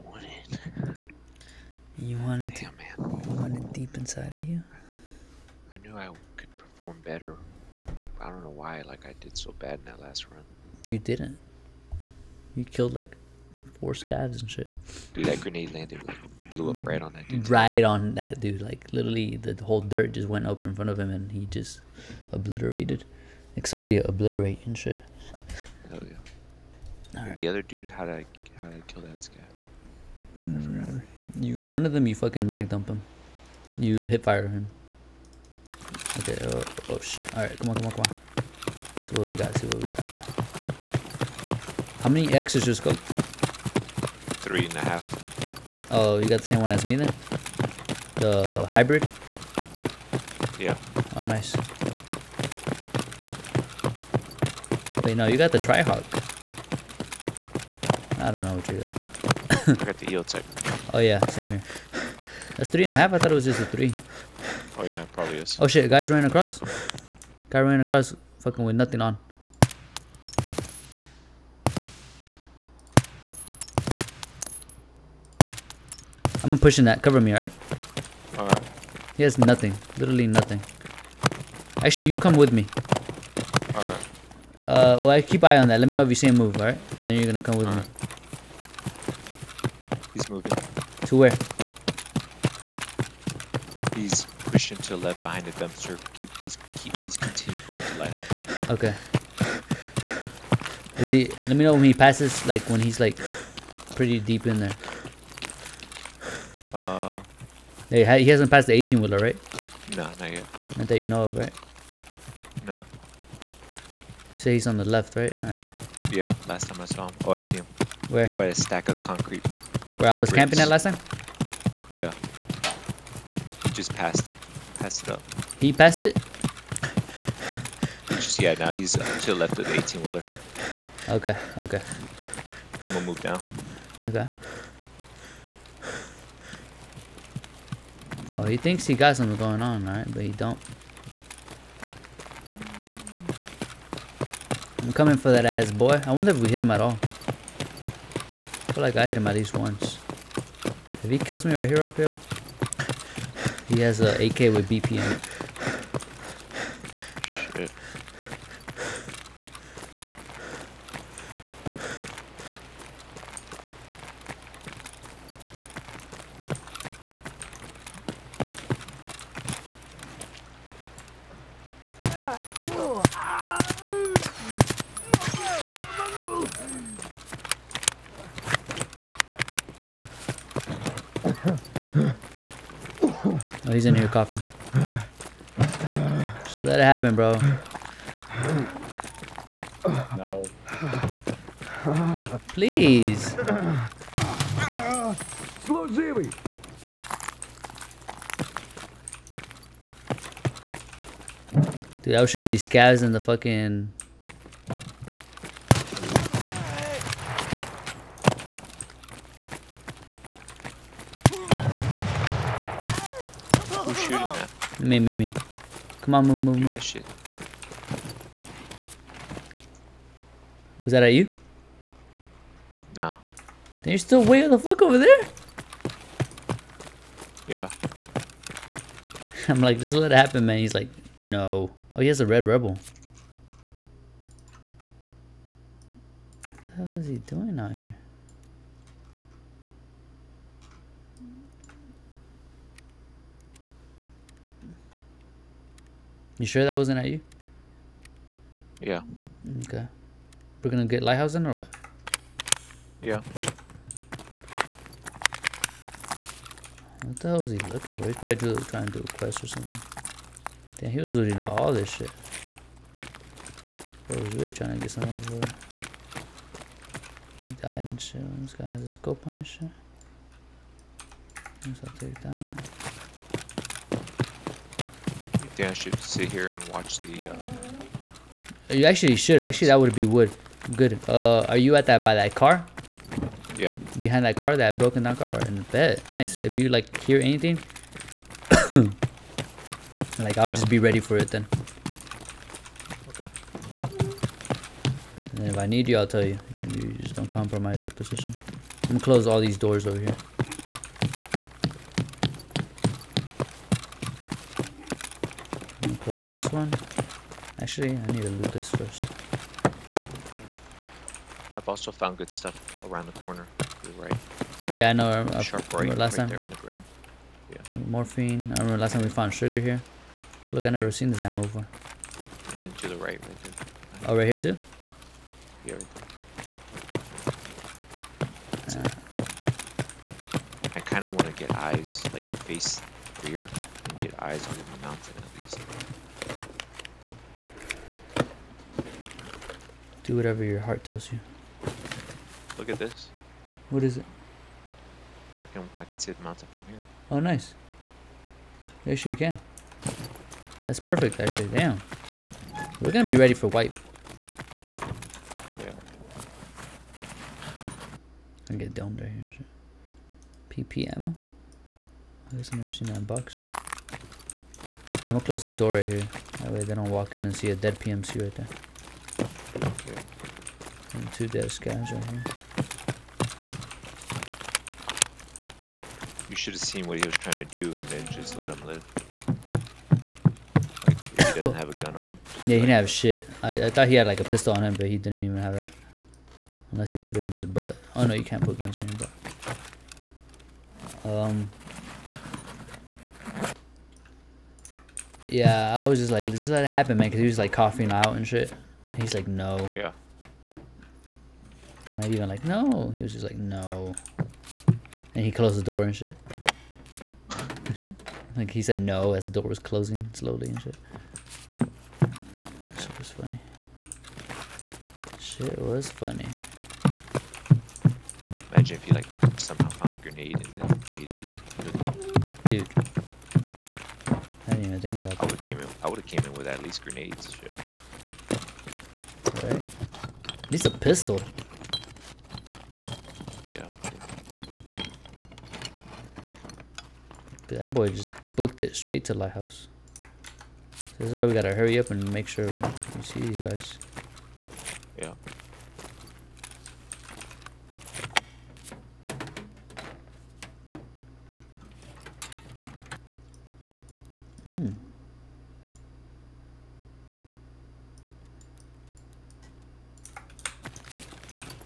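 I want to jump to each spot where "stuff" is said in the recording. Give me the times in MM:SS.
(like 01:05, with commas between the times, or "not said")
05:12.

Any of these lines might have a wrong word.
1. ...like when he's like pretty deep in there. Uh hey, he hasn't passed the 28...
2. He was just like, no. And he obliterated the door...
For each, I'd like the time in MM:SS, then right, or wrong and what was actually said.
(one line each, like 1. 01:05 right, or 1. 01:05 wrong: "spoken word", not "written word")
1. 01:42 wrong: "18", not "28"
2. 06:42 wrong: "closed", not "obliterated".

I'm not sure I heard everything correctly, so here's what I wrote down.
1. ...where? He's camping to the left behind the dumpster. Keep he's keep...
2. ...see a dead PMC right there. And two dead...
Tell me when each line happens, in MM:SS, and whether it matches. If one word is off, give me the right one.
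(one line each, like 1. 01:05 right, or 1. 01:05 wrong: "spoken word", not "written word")
1. 01:31 wrong: "pushing", not "camping"
2. 06:07 right.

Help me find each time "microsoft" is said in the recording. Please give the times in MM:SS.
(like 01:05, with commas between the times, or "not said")
not said.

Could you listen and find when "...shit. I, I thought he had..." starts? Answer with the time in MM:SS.
06:22.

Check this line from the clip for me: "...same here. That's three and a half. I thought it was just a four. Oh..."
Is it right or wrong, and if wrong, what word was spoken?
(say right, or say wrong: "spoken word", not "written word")
wrong: "three", not "four".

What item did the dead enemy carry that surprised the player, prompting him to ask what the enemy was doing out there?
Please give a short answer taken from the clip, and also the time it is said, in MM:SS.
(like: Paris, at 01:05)
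red rebel, at 03:52.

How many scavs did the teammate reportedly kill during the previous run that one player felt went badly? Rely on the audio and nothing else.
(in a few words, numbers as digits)
4.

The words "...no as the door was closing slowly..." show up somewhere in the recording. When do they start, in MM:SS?
06:48.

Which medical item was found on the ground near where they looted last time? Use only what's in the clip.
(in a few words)
Morphine.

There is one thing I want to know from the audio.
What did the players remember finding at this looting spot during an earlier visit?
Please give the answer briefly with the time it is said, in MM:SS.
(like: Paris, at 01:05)
sugar, at 05:19.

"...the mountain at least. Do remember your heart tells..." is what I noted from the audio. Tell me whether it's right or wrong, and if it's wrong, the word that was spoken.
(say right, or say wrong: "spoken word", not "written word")
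wrong: "whatever", not "remember".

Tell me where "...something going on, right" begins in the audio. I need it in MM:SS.
02:19.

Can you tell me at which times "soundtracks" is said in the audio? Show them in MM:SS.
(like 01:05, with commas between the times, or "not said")
not said.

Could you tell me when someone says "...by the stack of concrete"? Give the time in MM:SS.
01:58.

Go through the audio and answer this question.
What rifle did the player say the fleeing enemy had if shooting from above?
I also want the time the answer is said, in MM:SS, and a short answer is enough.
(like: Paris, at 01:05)
AK, at 02:34.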